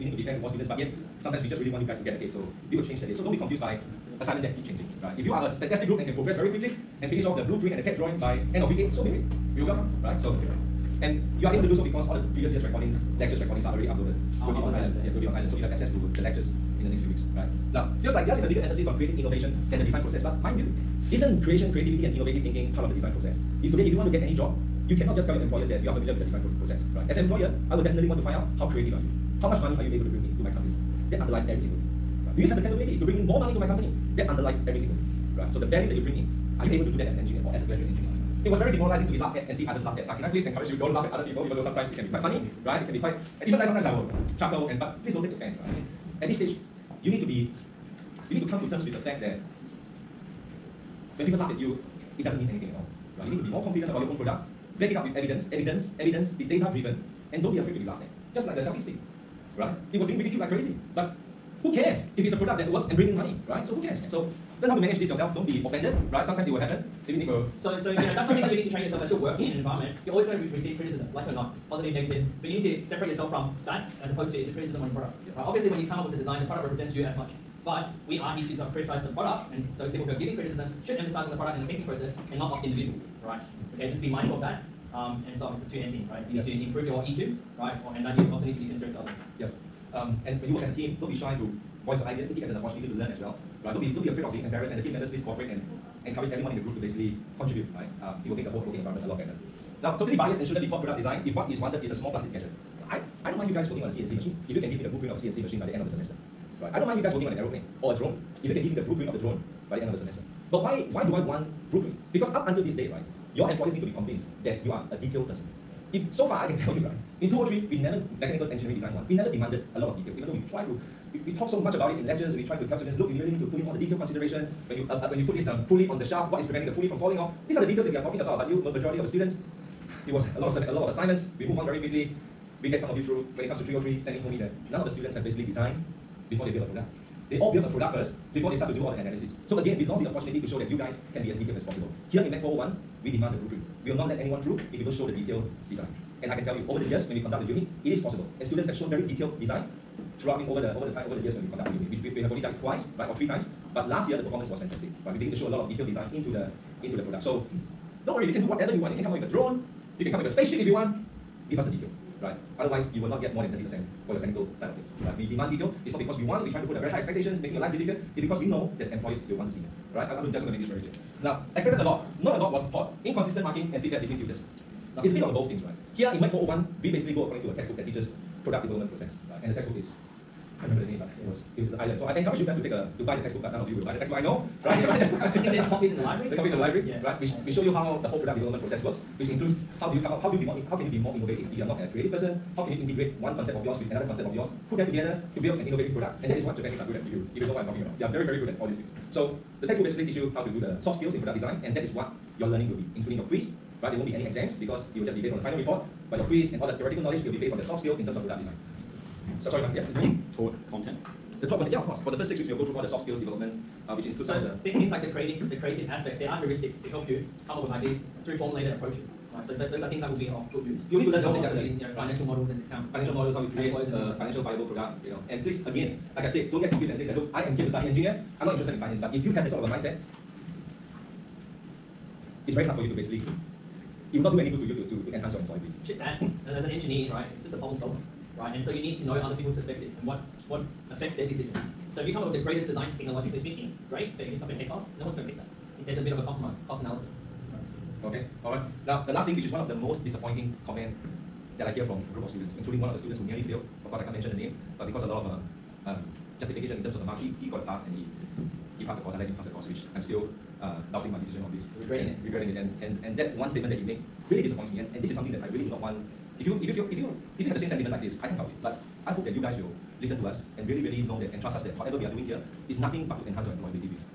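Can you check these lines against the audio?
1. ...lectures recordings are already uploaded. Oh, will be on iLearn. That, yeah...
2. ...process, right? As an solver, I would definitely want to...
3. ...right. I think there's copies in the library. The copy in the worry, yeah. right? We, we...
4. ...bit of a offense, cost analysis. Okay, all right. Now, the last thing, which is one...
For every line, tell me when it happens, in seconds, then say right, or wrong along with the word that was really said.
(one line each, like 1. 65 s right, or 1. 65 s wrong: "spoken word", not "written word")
1. 13 s right
2. 26 s wrong: "employer", not "solver"
3. 185 s wrong: "library", not "worry"
4. 246 s wrong: "compromise", not "offense".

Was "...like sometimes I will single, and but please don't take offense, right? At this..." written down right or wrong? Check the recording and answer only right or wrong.
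wrong.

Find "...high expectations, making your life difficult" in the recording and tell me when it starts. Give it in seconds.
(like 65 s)
166 s.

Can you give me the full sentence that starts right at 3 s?
So don't be confused by assignment that keep changing.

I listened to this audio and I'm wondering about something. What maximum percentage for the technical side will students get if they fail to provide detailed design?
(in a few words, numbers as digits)
30%.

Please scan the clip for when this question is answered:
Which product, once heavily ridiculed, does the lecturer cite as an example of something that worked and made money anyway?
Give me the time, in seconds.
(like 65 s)
58 s.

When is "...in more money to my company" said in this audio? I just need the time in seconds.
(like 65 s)
33 s.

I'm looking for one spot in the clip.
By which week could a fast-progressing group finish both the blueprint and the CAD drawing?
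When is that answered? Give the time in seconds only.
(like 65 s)
8 s.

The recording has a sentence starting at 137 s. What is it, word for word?
They all build a product first before they start to do all the analysis.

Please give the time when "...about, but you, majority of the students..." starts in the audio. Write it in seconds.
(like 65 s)
128 s.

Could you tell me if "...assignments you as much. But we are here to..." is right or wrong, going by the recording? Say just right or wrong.
wrong.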